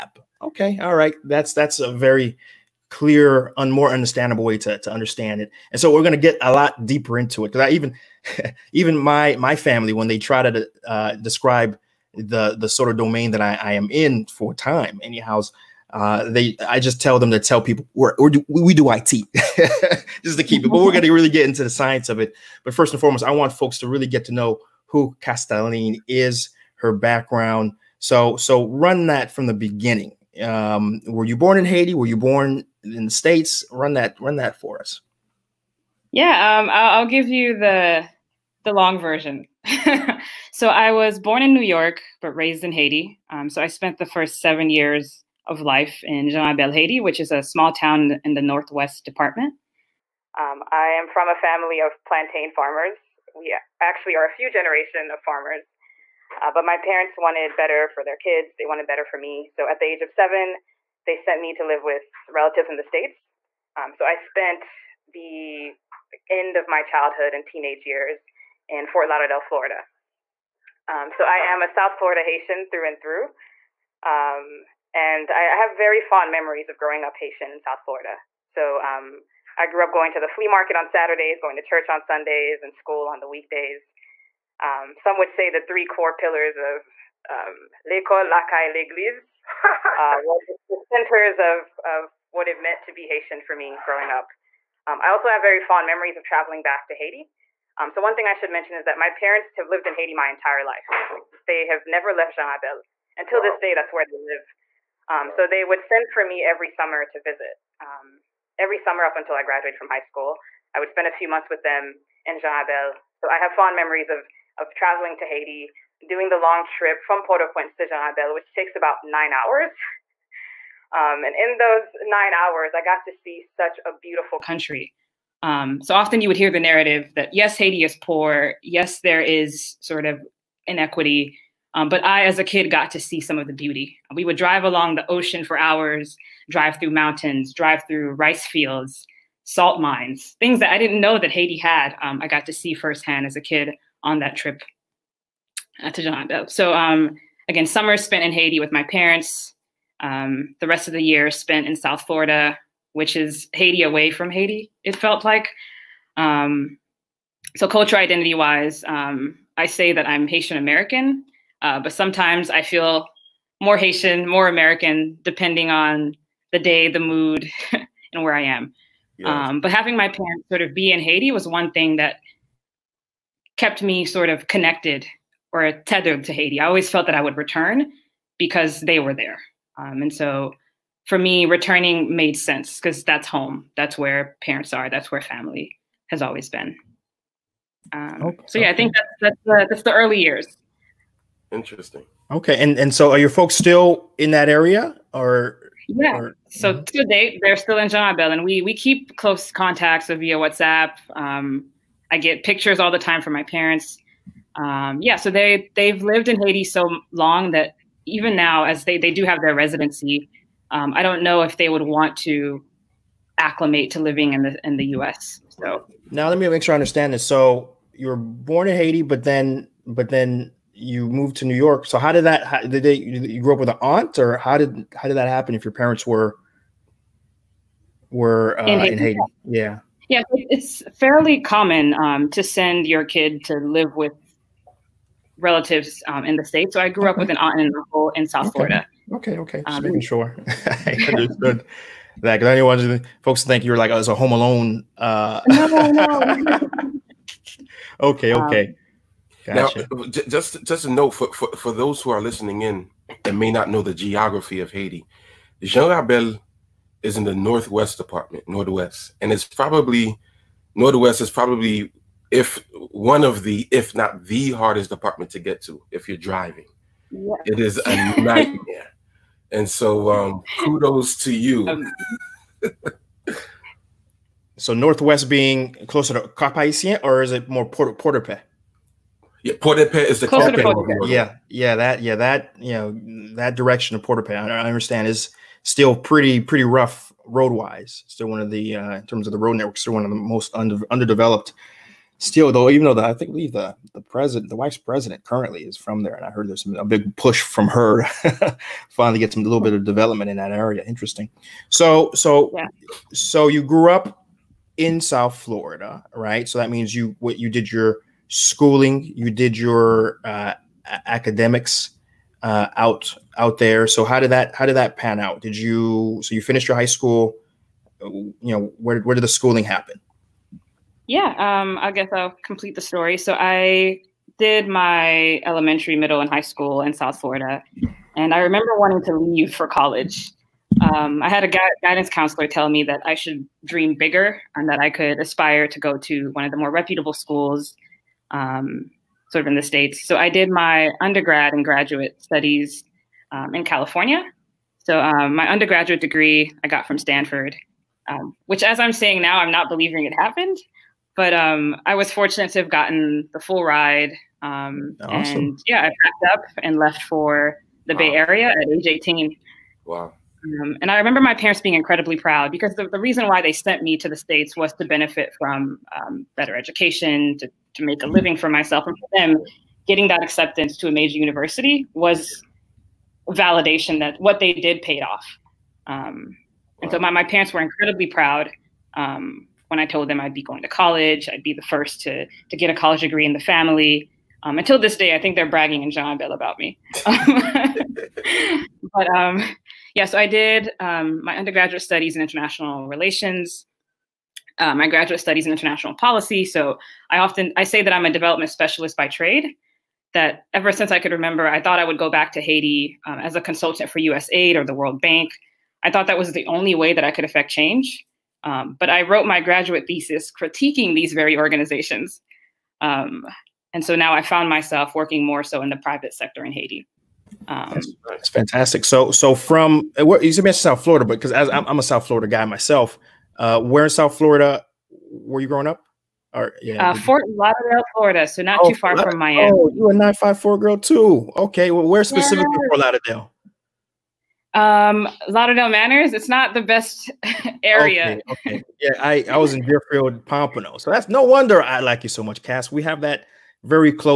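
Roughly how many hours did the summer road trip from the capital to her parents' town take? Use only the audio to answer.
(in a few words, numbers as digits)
9.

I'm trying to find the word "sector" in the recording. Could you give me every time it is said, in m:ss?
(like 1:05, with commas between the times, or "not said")
6:56.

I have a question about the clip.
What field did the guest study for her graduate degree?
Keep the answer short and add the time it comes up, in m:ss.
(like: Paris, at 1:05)
International policy, at 6:35.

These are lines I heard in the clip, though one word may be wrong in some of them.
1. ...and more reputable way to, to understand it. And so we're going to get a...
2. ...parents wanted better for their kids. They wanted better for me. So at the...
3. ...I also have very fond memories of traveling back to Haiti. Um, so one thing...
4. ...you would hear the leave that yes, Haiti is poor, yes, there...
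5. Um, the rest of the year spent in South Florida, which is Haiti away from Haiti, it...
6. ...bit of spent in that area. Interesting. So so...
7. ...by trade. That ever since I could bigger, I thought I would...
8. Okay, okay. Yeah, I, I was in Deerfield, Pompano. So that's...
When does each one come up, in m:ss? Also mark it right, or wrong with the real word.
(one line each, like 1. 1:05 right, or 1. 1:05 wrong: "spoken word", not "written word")
1. 0:03 wrong: "understandable", not "reputable"
2. 0:56 right
3. 1:35 right
4. 2:06 wrong: "narrative", not "leave"
5. 2:29 right
6. 4:59 wrong: "development", not "spent"
7. 6:38 wrong: "remember", not "bigger"
8. 7:18 right.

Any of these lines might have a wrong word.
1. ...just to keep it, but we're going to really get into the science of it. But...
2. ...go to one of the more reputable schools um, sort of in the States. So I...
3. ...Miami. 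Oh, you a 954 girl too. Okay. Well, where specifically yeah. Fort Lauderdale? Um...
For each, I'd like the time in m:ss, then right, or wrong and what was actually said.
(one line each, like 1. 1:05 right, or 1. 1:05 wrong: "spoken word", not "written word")
1. 0:20 right
2. 5:35 right
3. 7:09 right.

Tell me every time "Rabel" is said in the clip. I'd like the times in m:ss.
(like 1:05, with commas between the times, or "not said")
0:46, 1:42, 1:52, 1:58, 3:18, 4:15.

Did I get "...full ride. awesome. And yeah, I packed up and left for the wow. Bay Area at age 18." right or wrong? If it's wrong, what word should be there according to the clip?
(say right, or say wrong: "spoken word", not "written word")
right.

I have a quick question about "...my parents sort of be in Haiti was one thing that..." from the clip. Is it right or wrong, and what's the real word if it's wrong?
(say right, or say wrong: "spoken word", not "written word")
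right.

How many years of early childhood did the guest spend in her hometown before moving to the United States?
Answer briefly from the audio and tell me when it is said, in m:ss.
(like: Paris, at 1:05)
7, at 0:43.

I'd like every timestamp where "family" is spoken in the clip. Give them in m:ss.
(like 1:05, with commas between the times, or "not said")
0:09, 0:51, 3:05, 6:23.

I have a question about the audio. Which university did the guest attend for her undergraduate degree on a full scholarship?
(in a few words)
Stanford.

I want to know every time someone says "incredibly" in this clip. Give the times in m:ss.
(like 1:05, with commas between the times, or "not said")
6:01, 6:17.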